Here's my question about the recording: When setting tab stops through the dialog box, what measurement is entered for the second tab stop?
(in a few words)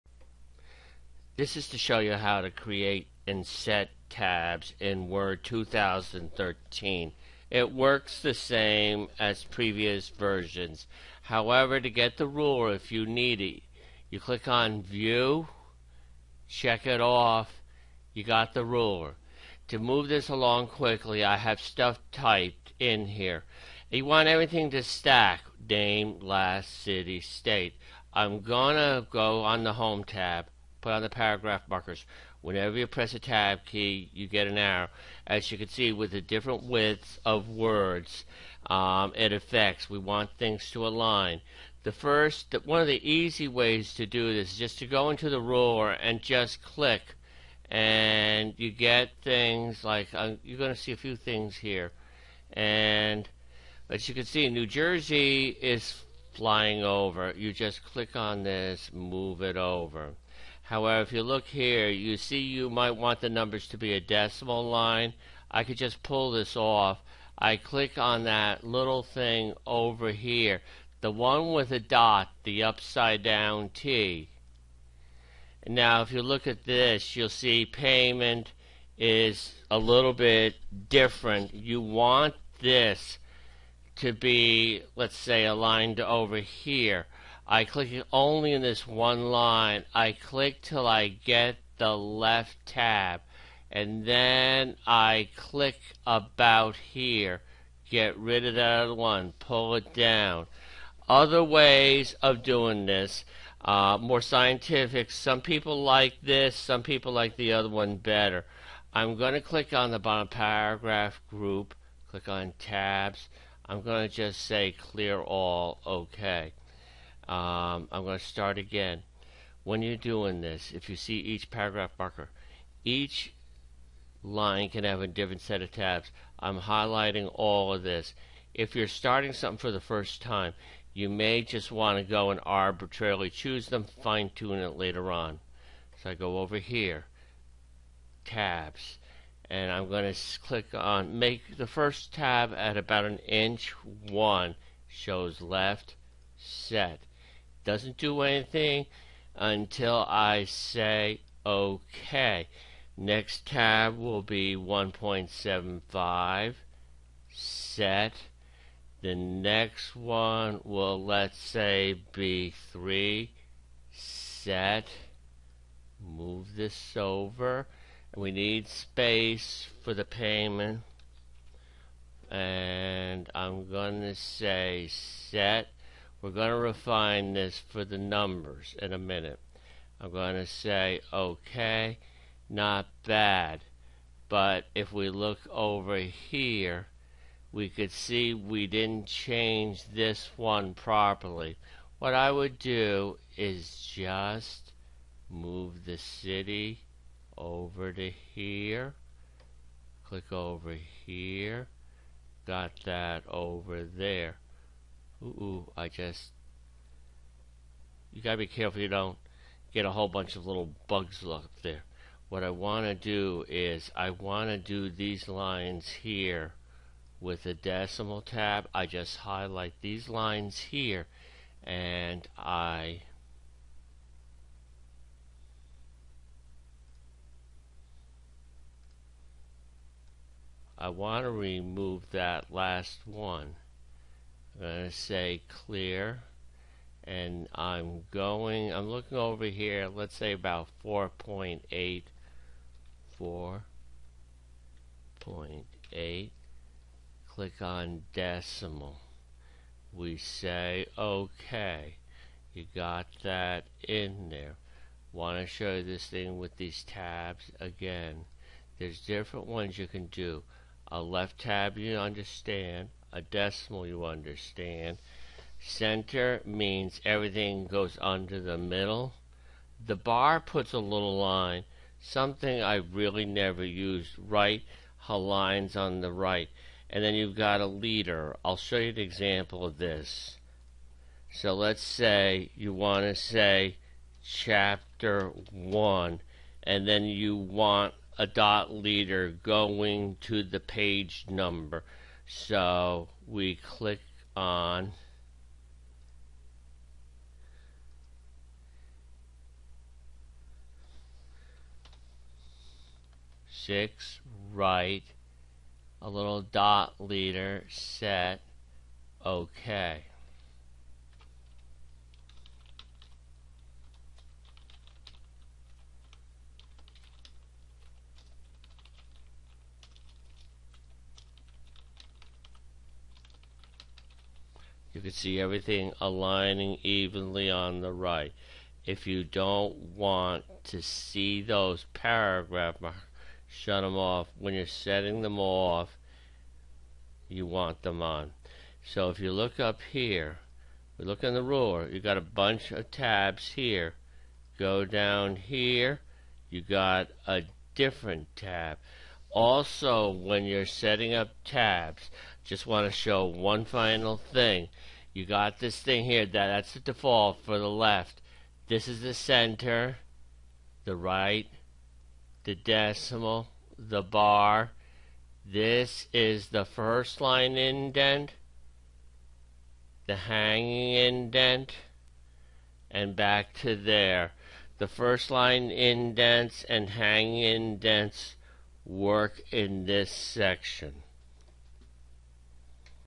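1.75.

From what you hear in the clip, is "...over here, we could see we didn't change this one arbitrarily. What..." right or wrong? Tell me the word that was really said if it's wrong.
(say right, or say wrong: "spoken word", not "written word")
wrong: "properly", not "arbitrarily".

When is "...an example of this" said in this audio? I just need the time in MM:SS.
04:38.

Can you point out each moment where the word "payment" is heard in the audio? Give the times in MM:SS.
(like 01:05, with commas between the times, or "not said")
01:17, 02:50.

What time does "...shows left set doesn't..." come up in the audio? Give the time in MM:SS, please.
02:24.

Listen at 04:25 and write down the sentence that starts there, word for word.
Center means everything goes under the middle.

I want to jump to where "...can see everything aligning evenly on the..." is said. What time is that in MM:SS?
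05:24.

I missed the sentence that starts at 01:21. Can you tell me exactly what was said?
You want this to be, let's say, aligned over here.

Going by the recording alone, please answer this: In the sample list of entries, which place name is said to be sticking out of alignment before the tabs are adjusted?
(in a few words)
New Jersey.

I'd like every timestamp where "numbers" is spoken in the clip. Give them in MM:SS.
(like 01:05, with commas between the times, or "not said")
01:03, 02:57, 04:51.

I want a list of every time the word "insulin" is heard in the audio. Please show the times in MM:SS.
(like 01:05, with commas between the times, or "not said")
not said.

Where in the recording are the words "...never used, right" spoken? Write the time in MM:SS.
04:33.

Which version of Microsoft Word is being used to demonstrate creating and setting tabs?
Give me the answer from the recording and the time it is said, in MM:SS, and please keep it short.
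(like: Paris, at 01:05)
Word 2013, at 00:05.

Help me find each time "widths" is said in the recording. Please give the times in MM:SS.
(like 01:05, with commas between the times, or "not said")
00:36.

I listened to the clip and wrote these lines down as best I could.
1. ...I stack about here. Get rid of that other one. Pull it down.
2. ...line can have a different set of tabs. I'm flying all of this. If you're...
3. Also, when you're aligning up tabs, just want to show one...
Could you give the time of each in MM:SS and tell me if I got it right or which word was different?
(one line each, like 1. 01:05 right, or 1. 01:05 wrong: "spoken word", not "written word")
1. 01:34 wrong: "click", not "stack"
2. 02:04 wrong: "highlighting", not "flying"
3. 05:49 wrong: "setting", not "aligning".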